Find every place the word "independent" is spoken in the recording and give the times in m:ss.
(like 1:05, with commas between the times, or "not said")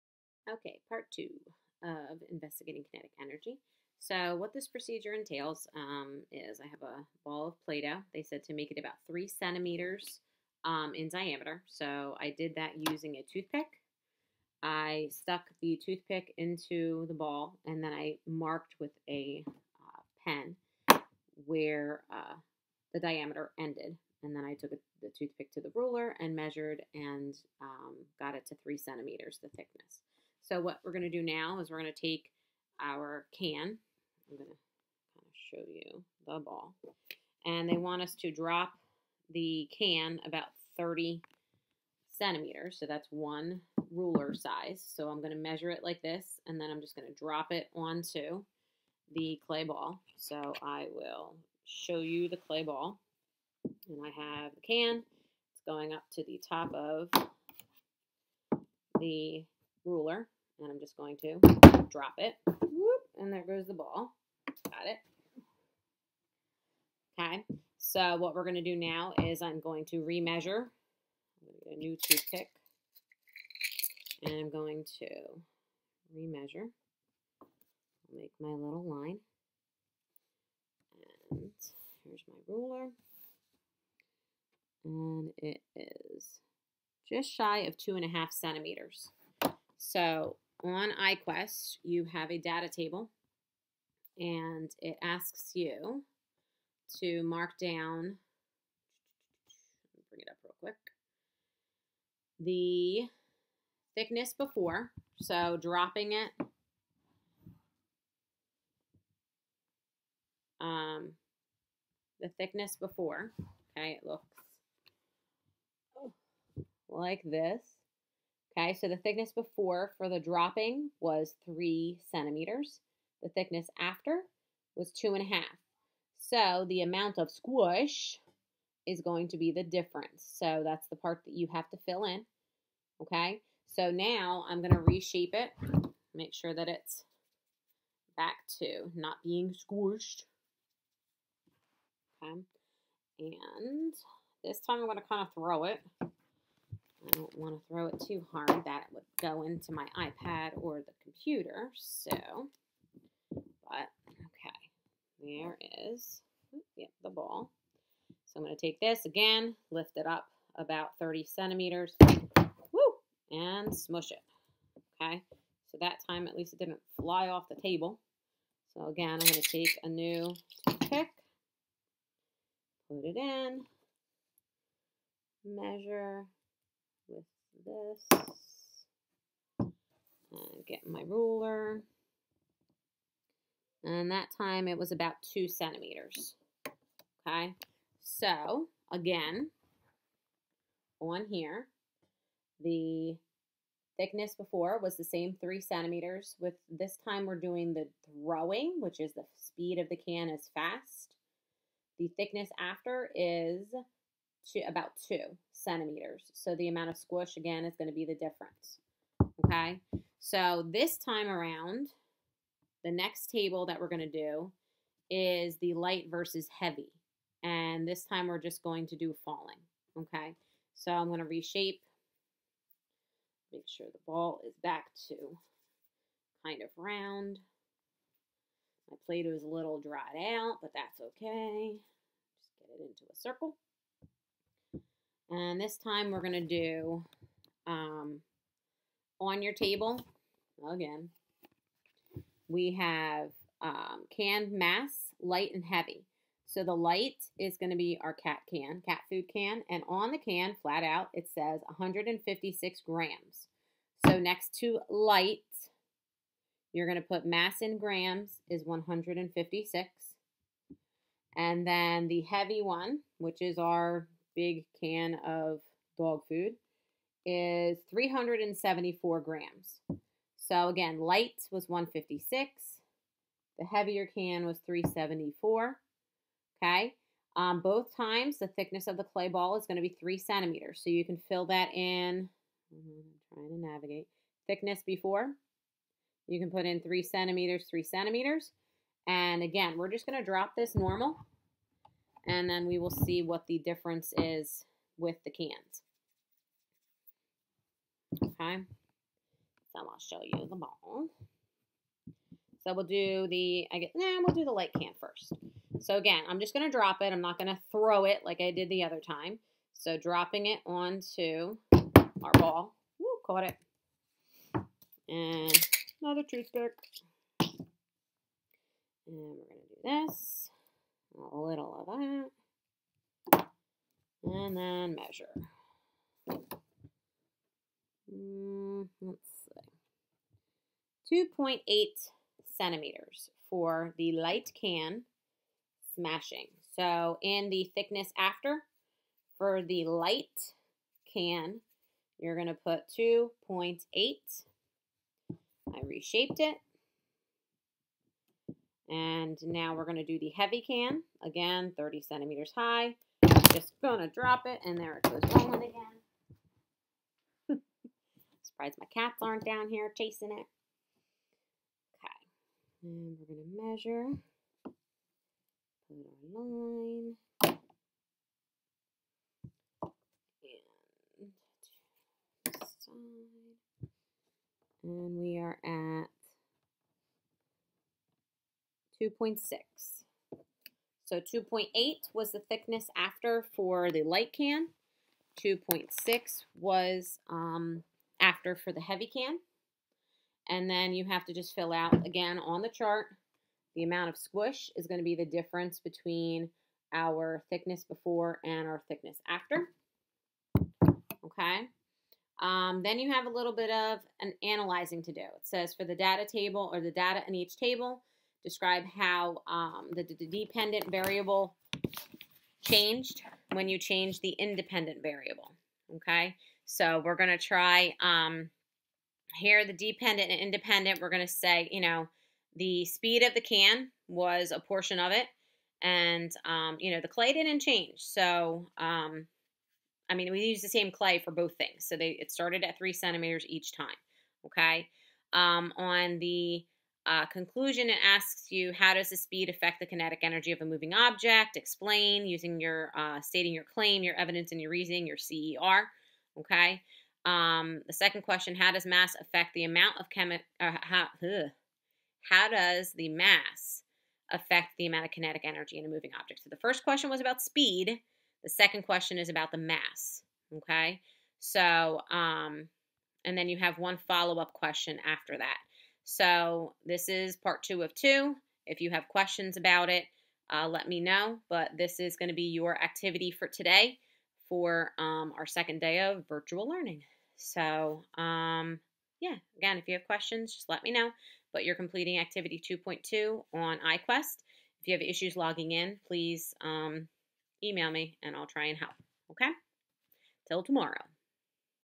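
6:54, 7:00.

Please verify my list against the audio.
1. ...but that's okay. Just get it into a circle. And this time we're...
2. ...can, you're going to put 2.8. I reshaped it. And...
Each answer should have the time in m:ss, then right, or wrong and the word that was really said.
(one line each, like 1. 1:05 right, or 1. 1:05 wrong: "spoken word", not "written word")
1. 3:50 right
2. 5:41 right.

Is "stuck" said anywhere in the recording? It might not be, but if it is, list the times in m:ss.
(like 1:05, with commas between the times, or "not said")
0:15.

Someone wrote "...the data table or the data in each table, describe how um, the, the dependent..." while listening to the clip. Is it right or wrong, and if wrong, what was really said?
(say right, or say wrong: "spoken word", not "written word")
right.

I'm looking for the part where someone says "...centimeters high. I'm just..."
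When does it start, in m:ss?
5:52.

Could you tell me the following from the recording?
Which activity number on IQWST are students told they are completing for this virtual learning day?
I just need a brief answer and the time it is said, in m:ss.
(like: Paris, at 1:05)
2.2, at 8:02.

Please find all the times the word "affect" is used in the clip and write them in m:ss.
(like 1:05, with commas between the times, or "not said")
7:19, 7:29, 7:34.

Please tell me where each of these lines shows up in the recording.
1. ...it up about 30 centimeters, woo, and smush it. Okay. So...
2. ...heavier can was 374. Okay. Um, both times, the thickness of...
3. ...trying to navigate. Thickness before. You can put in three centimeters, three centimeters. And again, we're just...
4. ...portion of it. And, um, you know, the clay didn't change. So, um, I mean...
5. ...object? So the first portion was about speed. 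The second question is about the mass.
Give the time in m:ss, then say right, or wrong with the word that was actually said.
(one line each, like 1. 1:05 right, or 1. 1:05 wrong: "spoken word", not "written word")
1. 2:39 right
2. 4:33 right
3. 4:43 right
4. 7:04 right
5. 7:36 wrong: "question", not "portion".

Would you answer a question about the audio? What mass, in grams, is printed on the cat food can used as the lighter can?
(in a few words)
156.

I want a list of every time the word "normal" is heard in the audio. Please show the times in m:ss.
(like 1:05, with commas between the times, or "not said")
4:50.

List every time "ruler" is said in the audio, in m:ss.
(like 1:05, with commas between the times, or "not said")
0:25, 0:43, 0:59, 1:22, 3:01.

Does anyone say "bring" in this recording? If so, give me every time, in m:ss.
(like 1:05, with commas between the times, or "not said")
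1:40.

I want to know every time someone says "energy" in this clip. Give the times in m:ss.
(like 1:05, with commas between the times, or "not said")
0:03, 7:20, 7:35.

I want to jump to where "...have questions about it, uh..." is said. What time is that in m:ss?
7:48.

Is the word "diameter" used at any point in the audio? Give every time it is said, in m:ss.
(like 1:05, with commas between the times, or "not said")
0:11, 0:22.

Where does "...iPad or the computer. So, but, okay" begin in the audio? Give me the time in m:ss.
2:29.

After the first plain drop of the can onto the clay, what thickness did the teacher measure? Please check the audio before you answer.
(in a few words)
just shy of 2.5 centimeters.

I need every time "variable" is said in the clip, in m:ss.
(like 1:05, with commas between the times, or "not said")
6:50, 6:55.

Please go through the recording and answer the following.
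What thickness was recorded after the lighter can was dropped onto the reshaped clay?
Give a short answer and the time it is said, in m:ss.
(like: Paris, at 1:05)
2.8 centimeters, at 5:31.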